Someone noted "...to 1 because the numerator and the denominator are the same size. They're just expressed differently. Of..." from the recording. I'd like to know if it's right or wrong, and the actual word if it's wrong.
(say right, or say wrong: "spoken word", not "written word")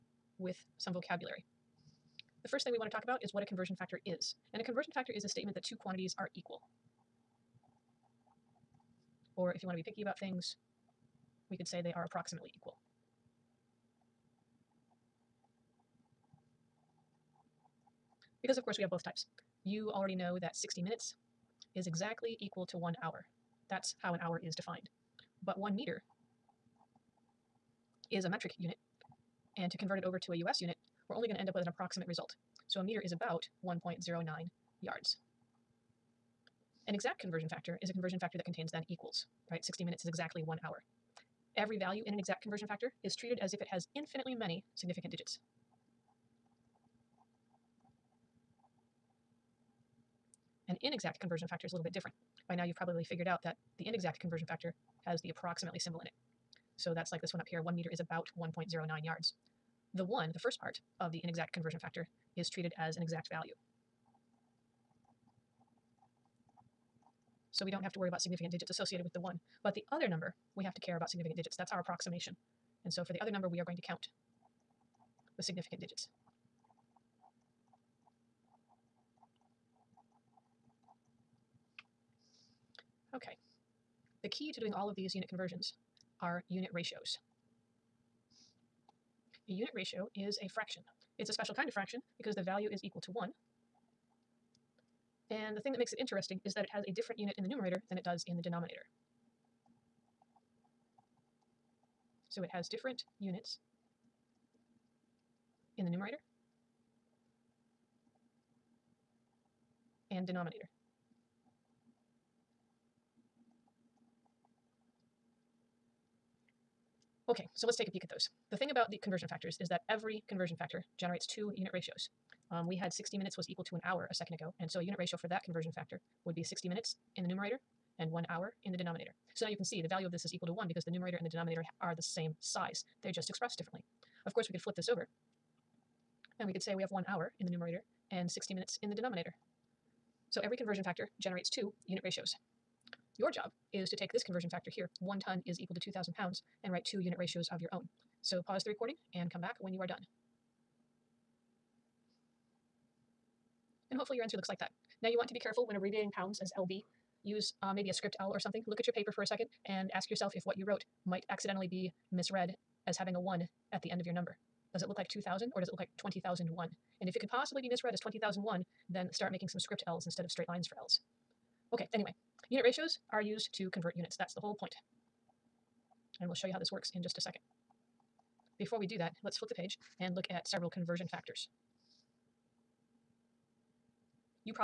right.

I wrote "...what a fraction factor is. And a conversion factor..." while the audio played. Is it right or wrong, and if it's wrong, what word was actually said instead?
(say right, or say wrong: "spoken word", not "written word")
wrong: "conversion", not "fraction".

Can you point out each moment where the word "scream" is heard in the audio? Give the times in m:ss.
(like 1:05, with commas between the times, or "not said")
not said.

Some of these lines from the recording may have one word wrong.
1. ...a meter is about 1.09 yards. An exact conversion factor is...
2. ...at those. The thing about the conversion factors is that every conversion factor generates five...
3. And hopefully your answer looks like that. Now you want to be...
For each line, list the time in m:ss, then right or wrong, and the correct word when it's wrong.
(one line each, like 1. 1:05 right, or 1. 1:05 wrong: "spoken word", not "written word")
1. 0:32 right
2. 1:58 wrong: "two", not "five"
3. 2:33 right.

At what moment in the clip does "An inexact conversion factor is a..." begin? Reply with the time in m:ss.
0:50.